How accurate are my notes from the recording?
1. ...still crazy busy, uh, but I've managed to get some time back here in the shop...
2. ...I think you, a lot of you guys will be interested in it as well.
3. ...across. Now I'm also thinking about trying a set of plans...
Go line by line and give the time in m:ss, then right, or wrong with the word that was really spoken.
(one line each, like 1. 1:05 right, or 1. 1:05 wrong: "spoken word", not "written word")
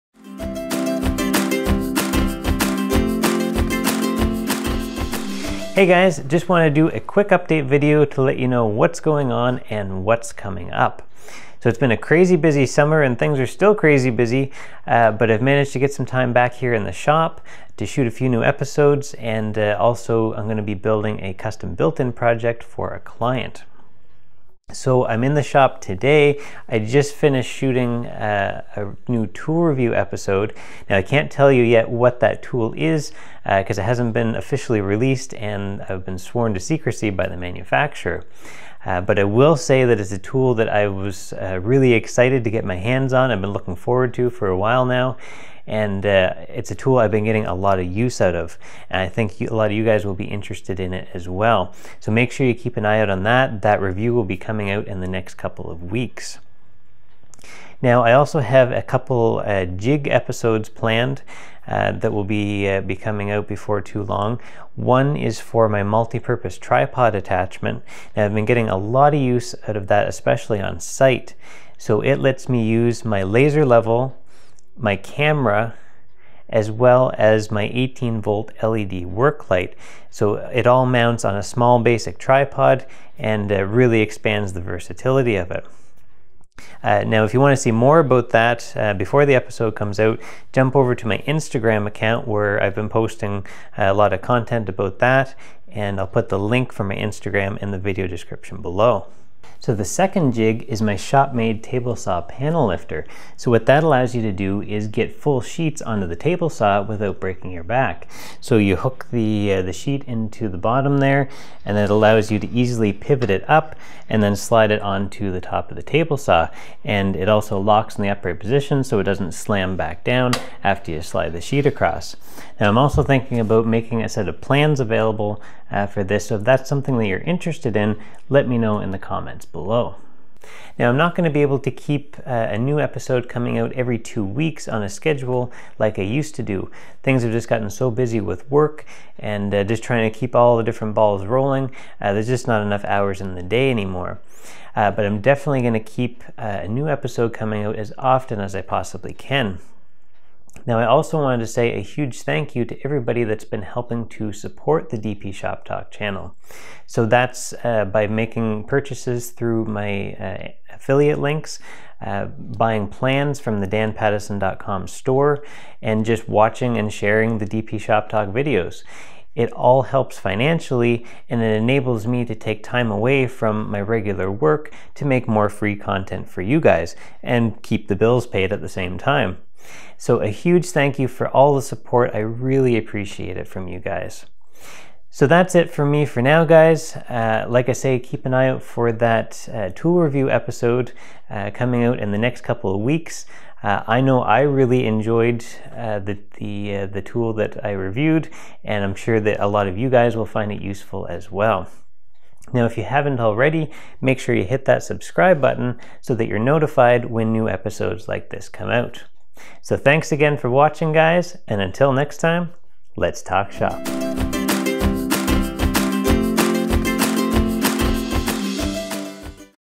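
1. 0:13 right
2. 0:49 right
3. 2:01 wrong: "making", not "trying".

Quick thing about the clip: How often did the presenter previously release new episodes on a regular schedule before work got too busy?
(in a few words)
every two weeks.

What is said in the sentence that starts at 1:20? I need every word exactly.
So it all mounts on a small basic tripod and uh, really expands the versatility of it.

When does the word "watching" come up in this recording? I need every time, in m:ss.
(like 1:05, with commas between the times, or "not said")
2:46, 3:30.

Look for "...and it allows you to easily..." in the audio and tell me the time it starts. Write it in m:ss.
1:51.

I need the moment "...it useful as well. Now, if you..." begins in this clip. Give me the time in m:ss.
3:20.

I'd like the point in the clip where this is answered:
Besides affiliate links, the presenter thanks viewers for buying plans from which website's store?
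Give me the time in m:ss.
2:43.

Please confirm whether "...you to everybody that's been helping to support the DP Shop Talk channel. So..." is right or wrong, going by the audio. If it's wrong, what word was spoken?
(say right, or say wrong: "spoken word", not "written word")
right.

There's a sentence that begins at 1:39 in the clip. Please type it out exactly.
So the second jig is my shop-made table saw panel lifter.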